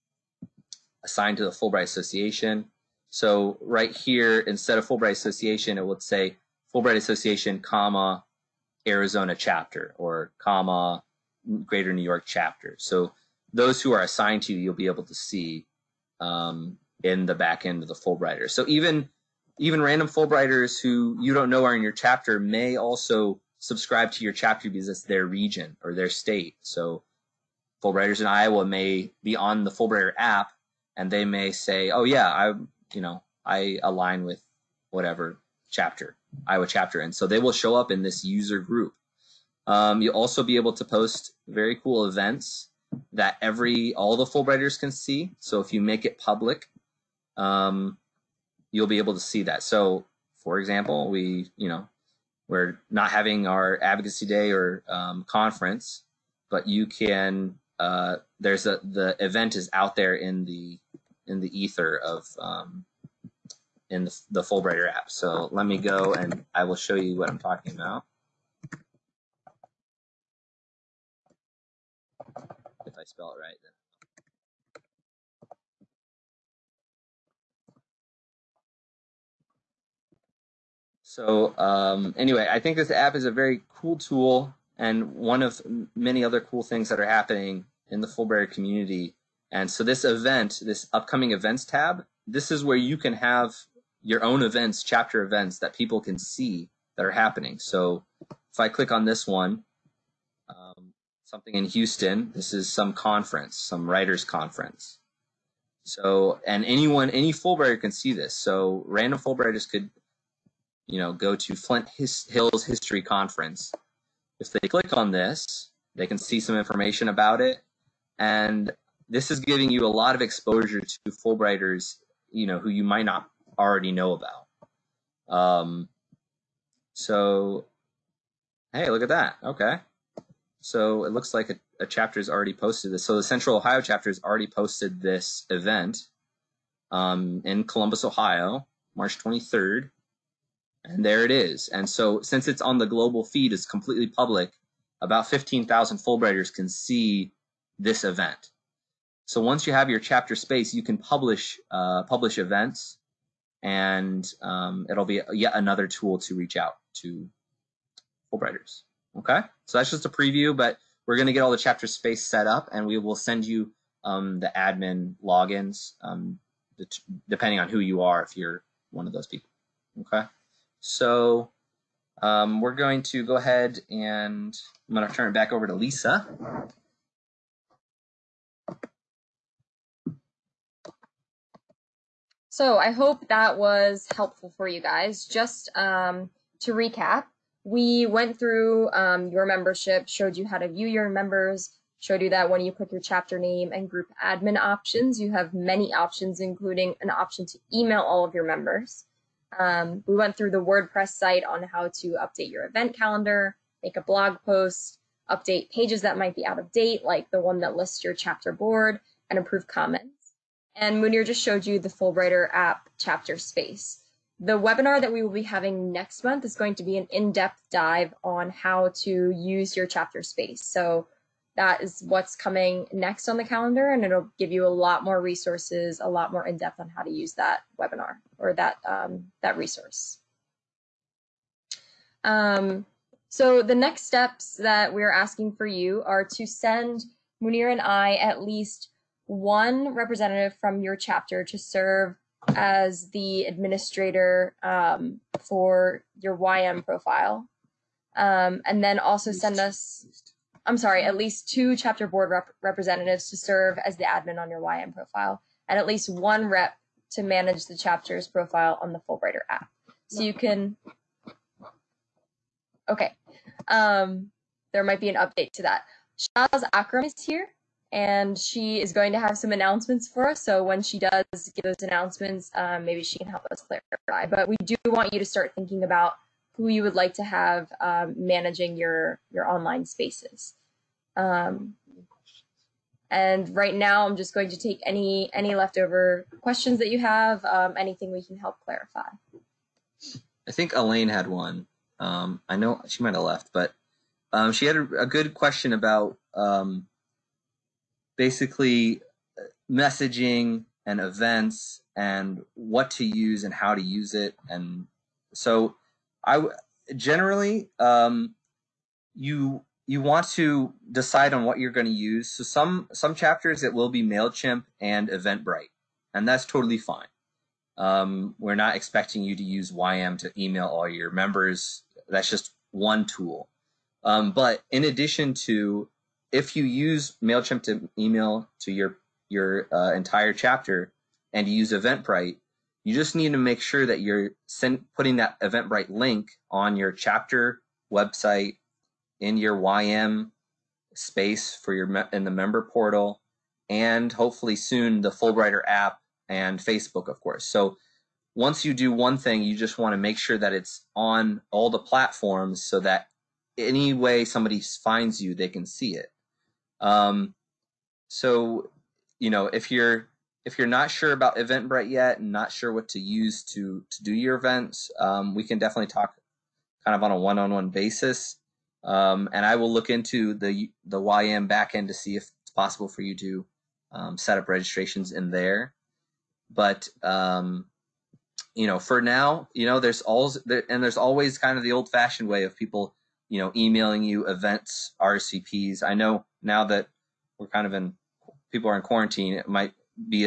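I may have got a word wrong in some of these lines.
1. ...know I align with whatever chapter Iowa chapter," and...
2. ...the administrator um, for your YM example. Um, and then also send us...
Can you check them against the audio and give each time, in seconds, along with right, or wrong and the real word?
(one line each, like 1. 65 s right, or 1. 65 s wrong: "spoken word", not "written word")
1. 33 s right
2. 243 s wrong: "profile", not "example".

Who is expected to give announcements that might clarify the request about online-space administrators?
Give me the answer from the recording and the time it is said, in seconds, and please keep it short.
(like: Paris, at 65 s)
Shaz Akram, at 266 s.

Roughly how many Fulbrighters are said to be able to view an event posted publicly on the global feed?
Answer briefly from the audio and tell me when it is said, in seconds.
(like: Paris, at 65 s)
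15,000, at 145 s.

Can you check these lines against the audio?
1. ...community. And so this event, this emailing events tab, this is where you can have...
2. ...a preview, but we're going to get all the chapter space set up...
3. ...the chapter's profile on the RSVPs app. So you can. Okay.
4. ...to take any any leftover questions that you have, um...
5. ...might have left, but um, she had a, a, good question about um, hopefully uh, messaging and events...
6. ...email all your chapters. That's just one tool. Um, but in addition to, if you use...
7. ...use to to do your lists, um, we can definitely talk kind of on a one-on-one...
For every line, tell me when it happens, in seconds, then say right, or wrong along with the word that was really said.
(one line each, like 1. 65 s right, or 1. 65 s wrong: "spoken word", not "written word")
1. 88 s wrong: "upcoming", not "emailing"
2. 160 s right
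3. 257 s wrong: "Fulbrighter", not "RSVPs"
4. 284 s right
5. 293 s wrong: "basically", not "hopefully"
6. 320 s wrong: "members", not "chapters"
7. 362 s wrong: "events", not "lists".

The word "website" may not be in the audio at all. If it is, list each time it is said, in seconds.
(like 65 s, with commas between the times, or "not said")
337 s.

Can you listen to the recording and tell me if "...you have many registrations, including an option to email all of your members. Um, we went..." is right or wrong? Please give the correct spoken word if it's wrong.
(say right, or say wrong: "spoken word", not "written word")
wrong: "options", not "registrations".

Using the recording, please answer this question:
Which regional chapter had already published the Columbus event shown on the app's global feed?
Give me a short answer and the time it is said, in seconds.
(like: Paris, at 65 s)
Central Ohio chapter, at 133 s.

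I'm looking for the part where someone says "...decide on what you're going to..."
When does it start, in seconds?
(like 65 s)
310 s.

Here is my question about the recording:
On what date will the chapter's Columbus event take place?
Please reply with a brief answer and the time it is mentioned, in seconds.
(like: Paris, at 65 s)
March 23rd, at 138 s.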